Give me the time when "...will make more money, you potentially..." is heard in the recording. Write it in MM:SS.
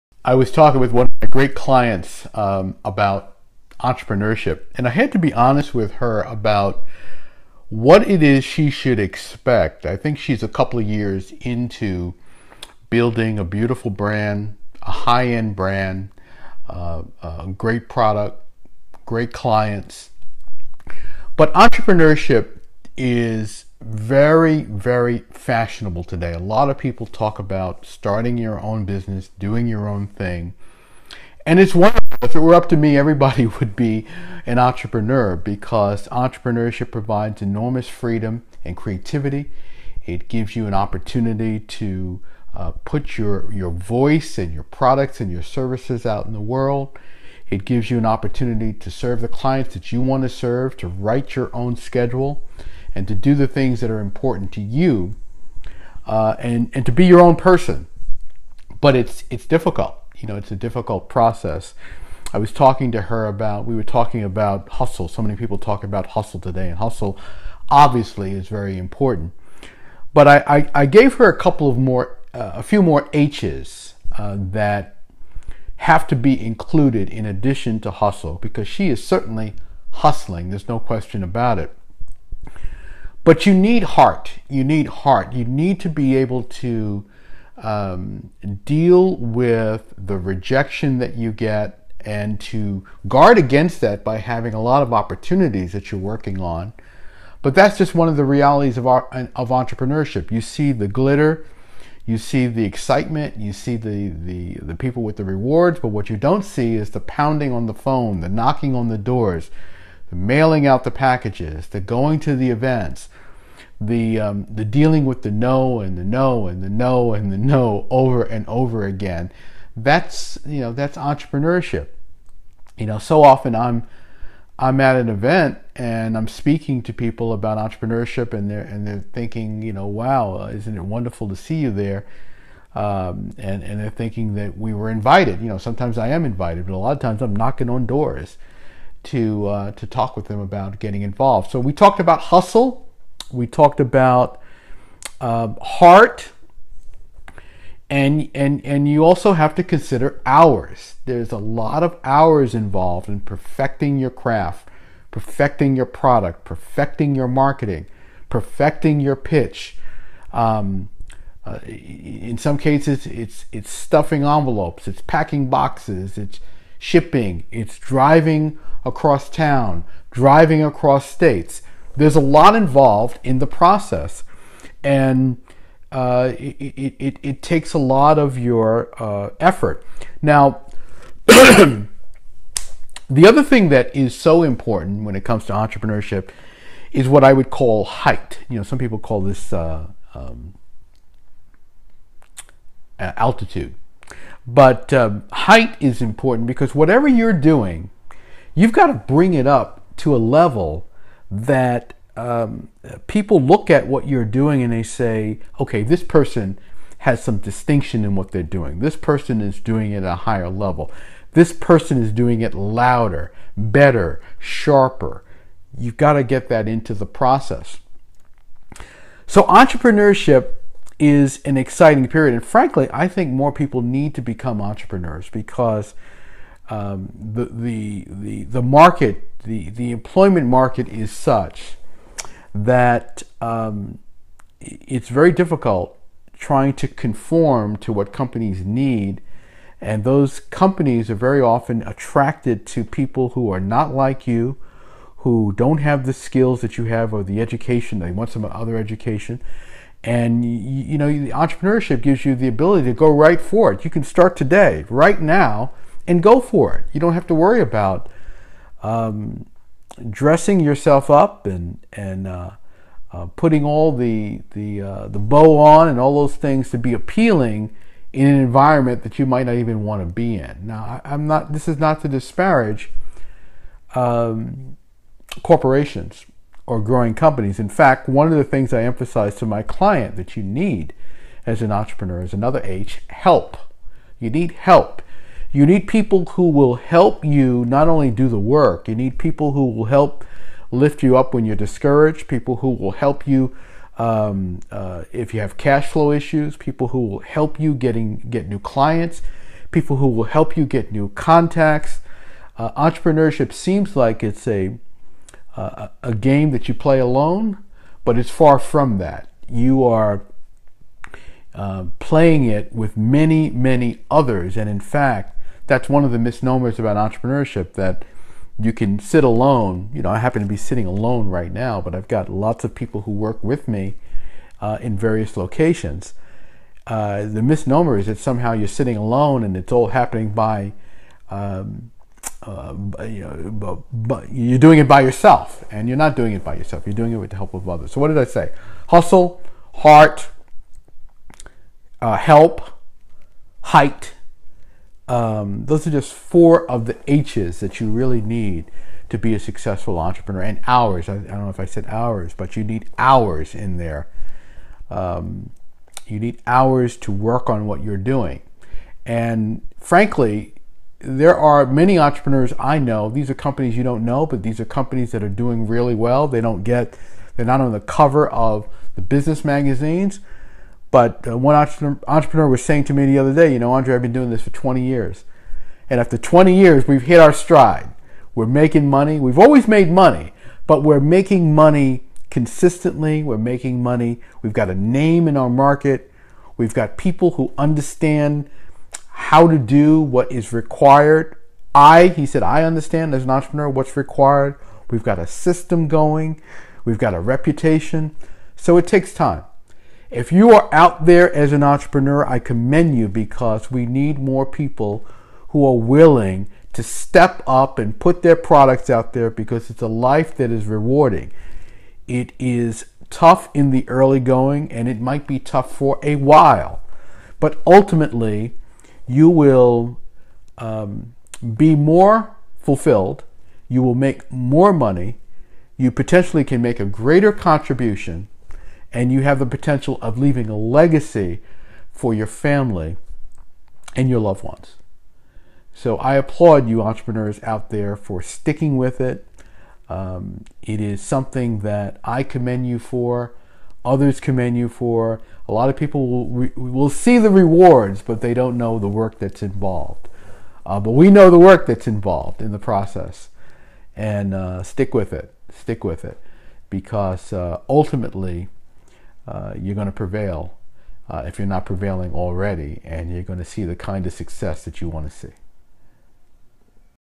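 07:03.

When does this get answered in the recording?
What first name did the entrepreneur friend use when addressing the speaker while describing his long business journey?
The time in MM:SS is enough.
06:13.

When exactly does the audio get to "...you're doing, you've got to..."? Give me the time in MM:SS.
03:17.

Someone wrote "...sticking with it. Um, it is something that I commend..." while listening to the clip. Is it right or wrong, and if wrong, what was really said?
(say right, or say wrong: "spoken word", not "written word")
right.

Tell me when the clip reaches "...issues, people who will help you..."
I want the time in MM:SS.
04:56.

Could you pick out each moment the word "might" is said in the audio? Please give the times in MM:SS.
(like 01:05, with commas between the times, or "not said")
04:29, 06:54.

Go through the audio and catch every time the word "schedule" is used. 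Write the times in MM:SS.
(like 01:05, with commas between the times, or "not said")
00:51.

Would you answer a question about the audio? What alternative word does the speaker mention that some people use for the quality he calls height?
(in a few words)
Altitude.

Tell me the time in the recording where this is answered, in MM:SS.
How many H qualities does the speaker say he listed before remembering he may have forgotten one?
05:46.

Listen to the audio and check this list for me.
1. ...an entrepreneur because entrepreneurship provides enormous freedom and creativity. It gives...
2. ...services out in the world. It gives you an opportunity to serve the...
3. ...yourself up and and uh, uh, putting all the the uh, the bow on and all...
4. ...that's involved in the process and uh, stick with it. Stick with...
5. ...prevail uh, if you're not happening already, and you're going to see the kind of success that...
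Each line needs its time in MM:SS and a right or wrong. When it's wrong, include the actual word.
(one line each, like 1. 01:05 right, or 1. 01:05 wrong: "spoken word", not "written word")
1. 00:34 right
2. 00:45 right
3. 04:20 right
4. 07:31 right
5. 07:39 wrong: "prevailing", not "happening".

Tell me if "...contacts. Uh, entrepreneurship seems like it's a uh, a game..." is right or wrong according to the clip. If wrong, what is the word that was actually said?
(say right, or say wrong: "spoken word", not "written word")
right.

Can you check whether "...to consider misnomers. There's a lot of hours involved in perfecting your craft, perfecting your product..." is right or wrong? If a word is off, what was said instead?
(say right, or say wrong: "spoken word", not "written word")
wrong: "hours", not "misnomers".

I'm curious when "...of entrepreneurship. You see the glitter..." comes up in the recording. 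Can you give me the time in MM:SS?
01:39.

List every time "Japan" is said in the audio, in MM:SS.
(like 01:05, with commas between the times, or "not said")
not said.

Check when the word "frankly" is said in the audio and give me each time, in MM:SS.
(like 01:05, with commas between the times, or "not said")
03:42, 05:59.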